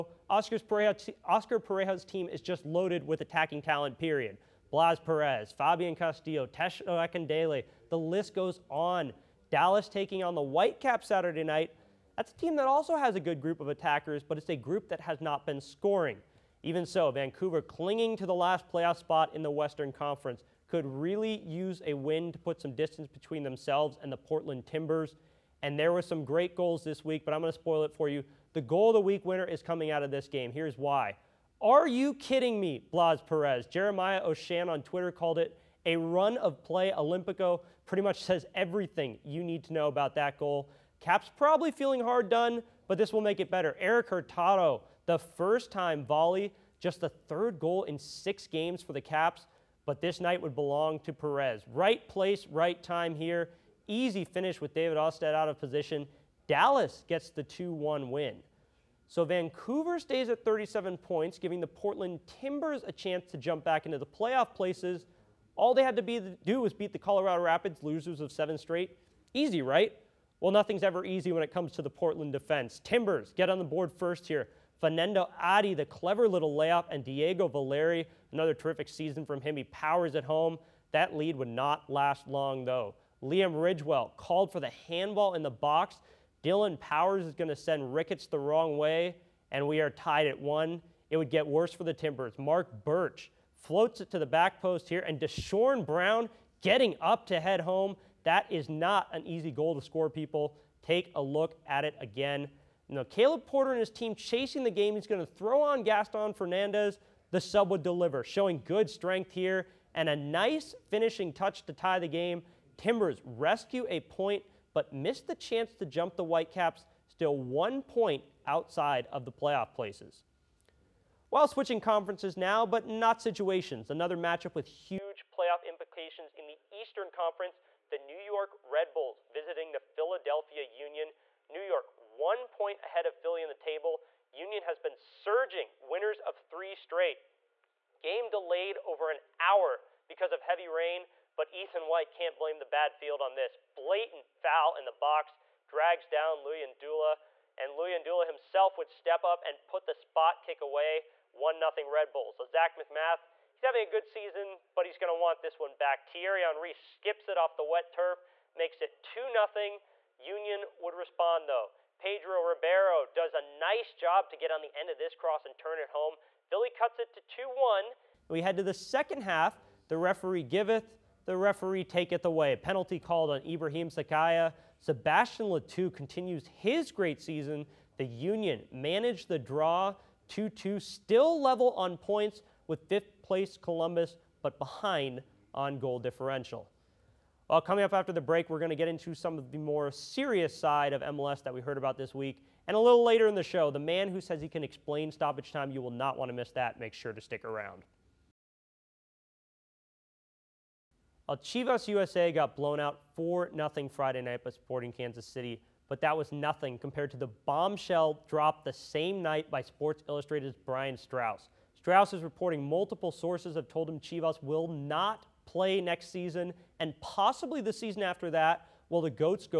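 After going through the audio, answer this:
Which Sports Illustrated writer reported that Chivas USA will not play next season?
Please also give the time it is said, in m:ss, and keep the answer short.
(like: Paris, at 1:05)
Brian Straus, at 3:30.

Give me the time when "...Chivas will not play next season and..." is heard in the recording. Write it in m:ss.
3:33.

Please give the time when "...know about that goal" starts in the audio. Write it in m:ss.
0:39.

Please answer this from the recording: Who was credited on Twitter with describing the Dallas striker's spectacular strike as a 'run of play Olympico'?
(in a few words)
Jeremiah Oshan.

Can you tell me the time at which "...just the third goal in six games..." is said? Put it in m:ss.
0:46.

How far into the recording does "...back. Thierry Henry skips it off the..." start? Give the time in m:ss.
2:35.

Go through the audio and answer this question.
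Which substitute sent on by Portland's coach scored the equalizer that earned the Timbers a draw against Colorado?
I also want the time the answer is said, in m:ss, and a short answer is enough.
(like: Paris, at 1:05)
Gaston Fernandez, at 1:45.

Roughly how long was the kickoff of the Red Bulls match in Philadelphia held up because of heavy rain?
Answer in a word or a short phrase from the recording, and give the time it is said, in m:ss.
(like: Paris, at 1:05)
over an hour, at 2:18.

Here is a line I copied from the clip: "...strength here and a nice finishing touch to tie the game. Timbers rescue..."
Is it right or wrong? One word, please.
right.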